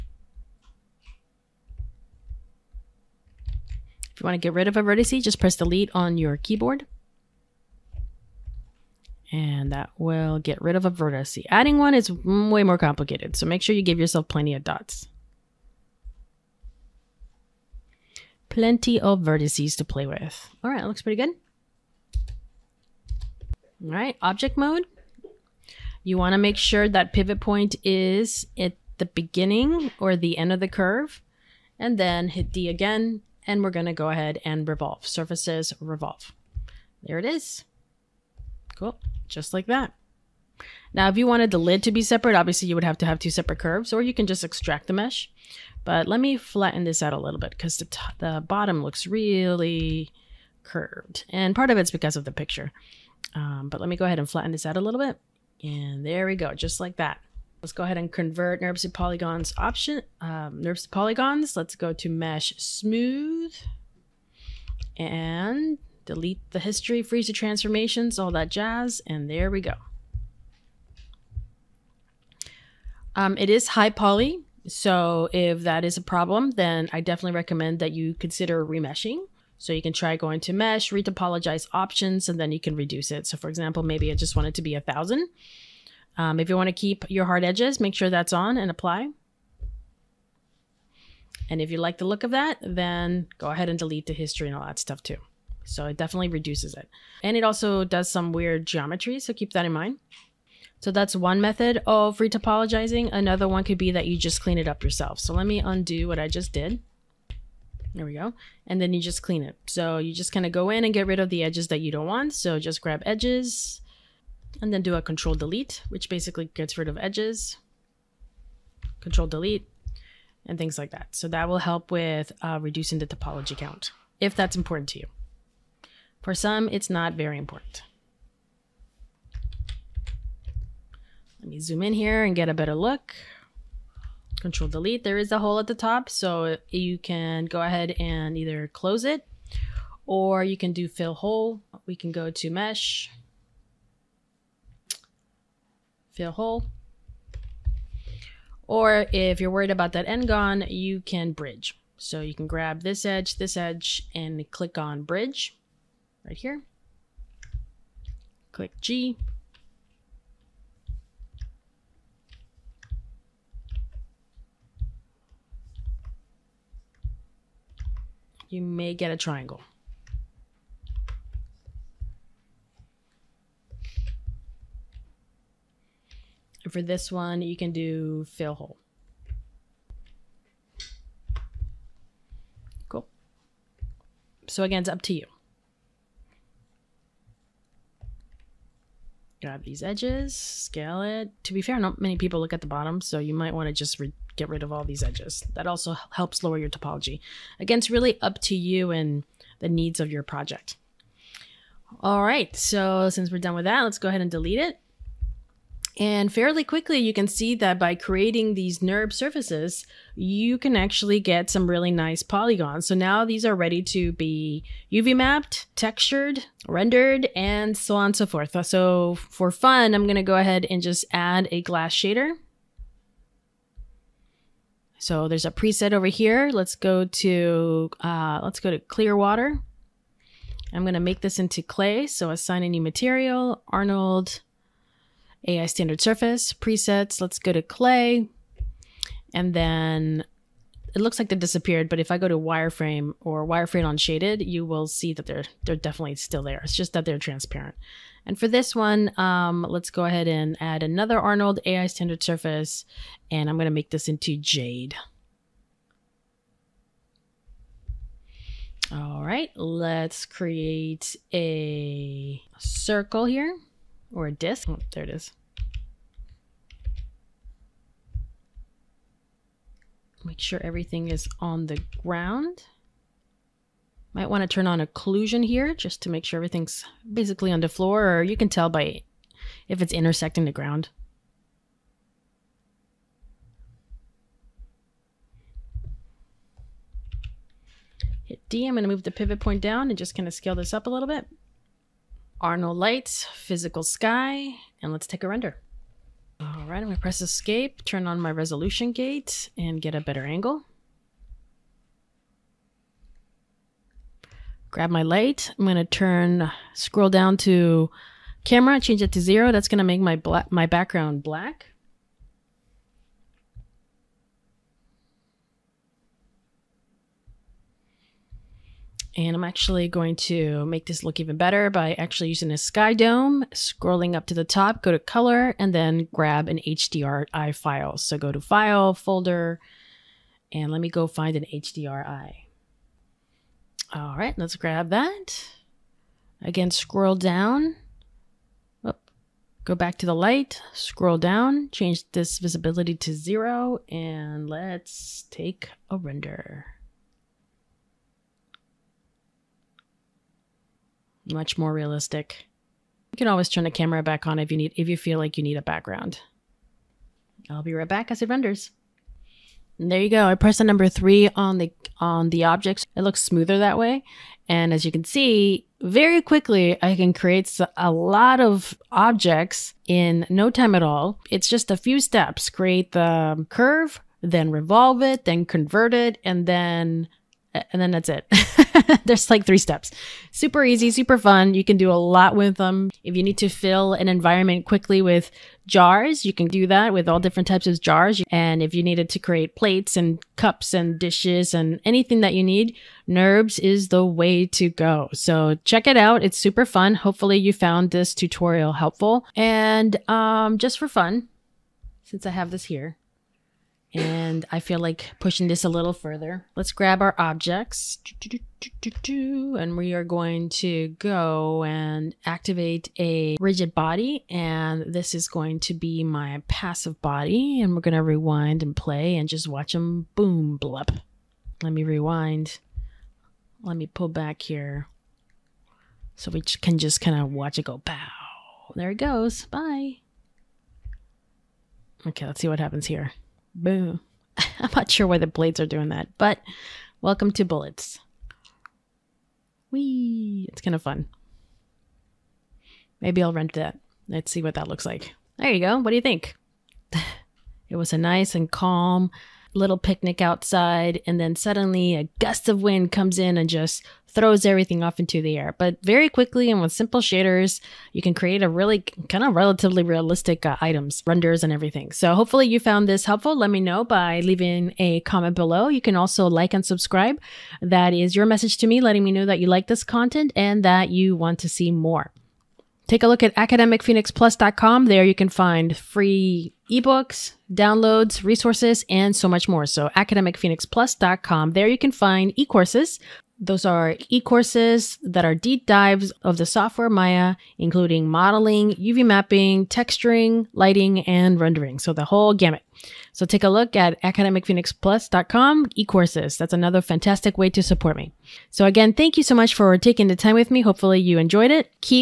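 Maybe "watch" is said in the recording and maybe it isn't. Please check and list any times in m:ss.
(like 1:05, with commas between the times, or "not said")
6:59, 7:07.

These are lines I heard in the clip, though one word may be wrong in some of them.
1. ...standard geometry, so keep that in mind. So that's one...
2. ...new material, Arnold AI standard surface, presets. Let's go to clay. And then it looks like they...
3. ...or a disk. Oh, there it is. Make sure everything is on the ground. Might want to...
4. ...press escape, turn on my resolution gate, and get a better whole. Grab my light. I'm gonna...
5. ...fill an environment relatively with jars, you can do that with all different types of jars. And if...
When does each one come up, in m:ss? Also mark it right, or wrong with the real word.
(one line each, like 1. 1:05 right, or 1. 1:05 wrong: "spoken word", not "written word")
1. 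1:38 wrong: "weird", not "standard"
2. 3:52 right
3. 4:24 right
4. 4:56 wrong: "angle", not "whole"
5. 6:23 wrong: "quickly", not "relatively".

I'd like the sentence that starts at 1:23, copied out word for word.
So for example, maybe I just want it to be a thousand.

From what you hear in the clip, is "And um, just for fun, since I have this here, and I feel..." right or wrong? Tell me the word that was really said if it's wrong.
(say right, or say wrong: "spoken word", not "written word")
right.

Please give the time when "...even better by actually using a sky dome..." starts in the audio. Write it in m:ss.
5:21.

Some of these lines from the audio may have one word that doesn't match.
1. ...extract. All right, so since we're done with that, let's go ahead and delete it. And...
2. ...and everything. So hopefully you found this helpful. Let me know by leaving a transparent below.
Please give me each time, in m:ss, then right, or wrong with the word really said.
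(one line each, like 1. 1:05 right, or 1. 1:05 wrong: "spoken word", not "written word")
1. 3:20 wrong: "project", not "extract"
2. 7:41 wrong: "comment", not "transparent".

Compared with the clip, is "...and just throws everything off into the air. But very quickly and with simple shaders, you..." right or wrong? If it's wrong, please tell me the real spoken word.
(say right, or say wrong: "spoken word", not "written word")
right.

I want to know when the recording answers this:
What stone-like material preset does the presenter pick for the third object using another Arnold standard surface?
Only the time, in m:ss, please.
4:14.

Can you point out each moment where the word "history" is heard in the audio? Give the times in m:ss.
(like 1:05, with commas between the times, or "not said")
1:06, 1:34.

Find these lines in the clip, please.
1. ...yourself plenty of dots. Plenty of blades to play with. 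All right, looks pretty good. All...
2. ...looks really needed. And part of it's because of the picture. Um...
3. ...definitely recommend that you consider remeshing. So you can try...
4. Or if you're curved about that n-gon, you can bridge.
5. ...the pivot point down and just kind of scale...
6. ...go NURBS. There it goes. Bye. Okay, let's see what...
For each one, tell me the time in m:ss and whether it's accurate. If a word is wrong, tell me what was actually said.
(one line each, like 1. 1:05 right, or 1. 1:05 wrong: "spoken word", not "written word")
1. 0:13 wrong: "vertices", not "blades"
2. 0:48 wrong: "curved", not "needed"
3. 1:17 right
4. 2:28 wrong: "worried", not "curved"
5. 4:49 right
6. 7:07 wrong: "Bow", not "NURBS".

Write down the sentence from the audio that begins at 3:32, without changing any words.
So now these are ready to be UV mapped, textured, rendered, and so on and so forth.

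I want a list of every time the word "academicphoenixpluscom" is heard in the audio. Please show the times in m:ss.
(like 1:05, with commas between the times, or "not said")
7:53, 7:59, 8:14.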